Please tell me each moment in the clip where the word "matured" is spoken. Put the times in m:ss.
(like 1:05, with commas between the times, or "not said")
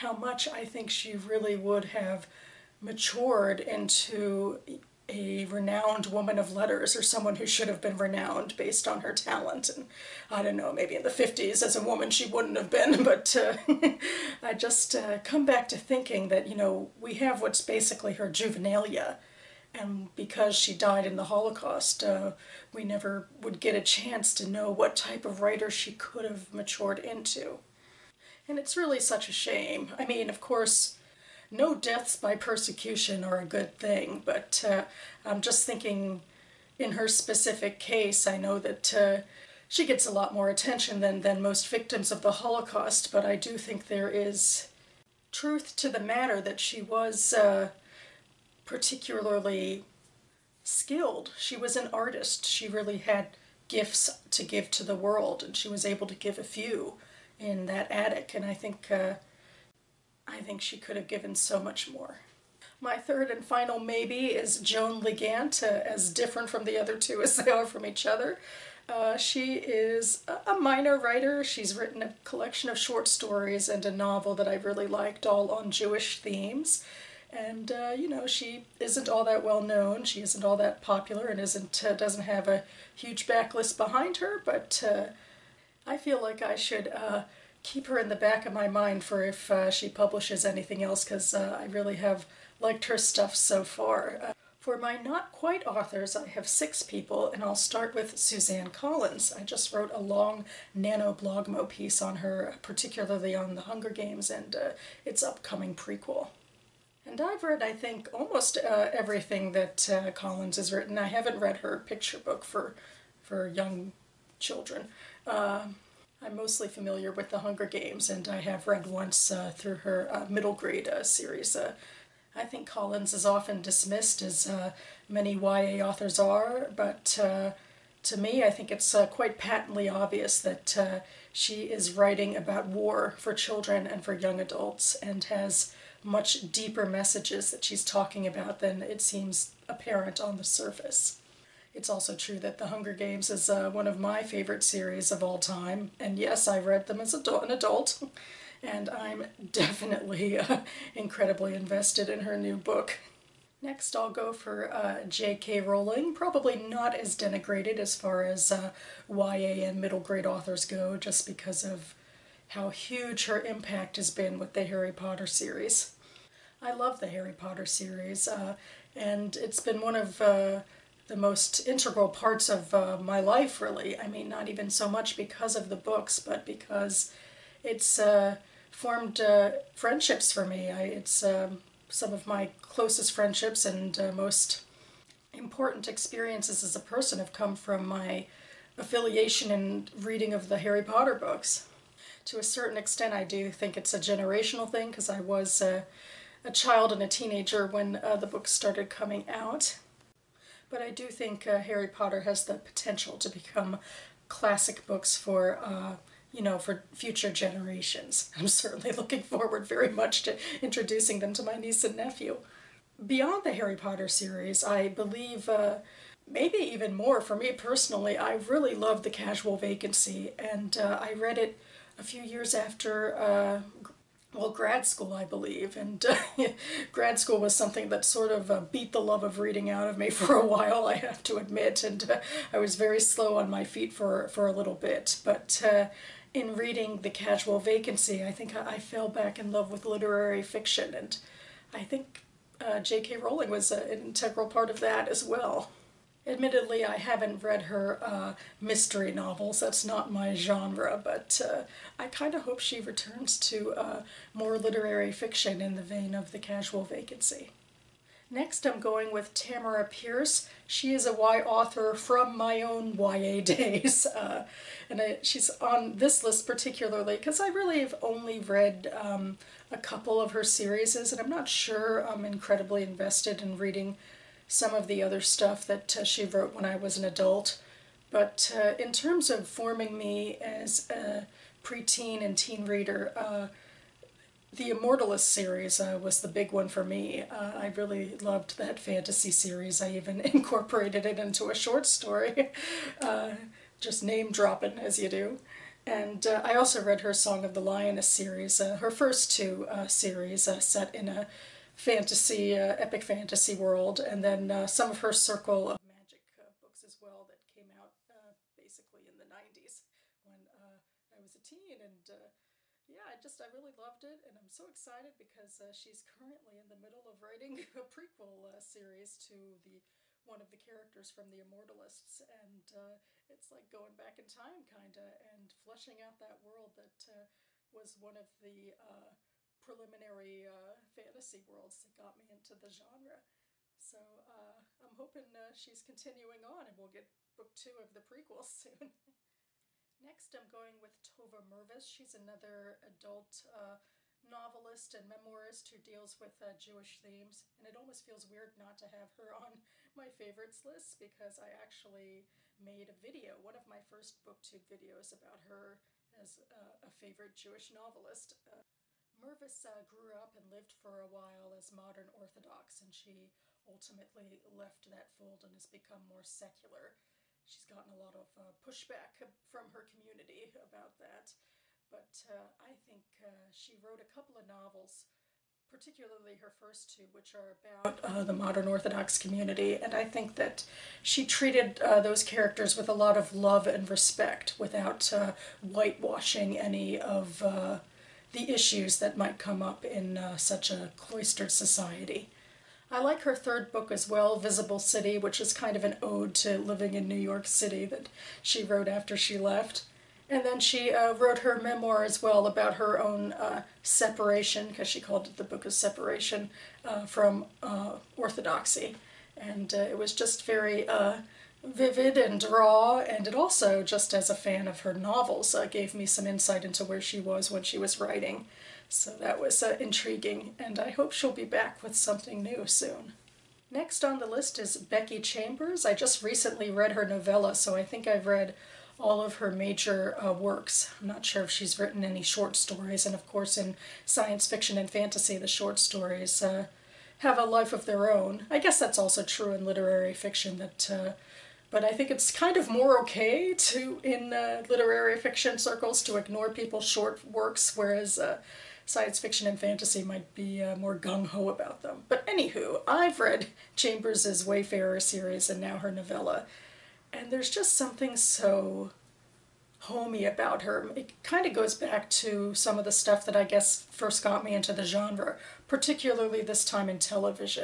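0:02, 0:26.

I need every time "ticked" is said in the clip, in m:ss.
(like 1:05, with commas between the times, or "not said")
not said.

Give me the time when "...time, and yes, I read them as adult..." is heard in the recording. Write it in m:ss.
2:25.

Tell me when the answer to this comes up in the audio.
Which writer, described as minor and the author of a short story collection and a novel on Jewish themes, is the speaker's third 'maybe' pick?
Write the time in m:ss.
1:04.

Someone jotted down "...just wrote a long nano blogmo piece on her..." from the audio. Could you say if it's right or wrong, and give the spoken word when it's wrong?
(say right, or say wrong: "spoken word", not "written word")
right.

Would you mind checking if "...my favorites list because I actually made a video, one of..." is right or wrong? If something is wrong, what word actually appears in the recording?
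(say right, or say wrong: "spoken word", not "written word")
right.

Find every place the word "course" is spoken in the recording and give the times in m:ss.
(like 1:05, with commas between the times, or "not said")
0:30, 7:13.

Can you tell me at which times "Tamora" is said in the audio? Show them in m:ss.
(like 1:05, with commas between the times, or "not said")
4:19.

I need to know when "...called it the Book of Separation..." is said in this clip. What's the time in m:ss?
6:44.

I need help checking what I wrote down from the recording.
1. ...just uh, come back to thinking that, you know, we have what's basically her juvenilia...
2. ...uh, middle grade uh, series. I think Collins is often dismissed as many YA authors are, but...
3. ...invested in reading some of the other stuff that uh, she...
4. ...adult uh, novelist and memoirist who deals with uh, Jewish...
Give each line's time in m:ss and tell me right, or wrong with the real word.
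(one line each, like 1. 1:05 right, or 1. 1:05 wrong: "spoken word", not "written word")
1. 0:14 right
2. 2:00 right
3. 4:32 right
4. 5:42 right.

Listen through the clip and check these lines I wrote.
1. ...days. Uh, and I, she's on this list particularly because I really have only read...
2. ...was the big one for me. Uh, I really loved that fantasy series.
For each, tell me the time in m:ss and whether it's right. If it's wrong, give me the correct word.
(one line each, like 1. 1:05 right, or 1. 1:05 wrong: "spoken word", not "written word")
1. 4:23 right
2. 4:46 right.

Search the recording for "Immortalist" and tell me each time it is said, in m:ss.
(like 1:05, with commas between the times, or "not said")
4:44, 5:21.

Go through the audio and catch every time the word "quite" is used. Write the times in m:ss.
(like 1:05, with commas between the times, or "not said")
1:35, 2:09.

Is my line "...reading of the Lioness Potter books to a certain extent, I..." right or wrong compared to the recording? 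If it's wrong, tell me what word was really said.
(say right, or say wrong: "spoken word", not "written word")
wrong: "Harry", not "Lioness".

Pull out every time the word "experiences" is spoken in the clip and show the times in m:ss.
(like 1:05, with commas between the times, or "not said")
3:05.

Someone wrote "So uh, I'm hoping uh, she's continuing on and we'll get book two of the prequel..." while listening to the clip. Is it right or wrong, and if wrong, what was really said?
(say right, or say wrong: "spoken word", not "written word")
right.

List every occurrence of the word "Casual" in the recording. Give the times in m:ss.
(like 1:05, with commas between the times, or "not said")
3:39, 3:57, 4:16.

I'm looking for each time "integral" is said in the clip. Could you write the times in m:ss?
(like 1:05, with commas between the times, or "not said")
2:51, 4:03.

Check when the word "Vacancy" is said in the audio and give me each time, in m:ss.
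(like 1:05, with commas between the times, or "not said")
3:39, 3:57, 4:16.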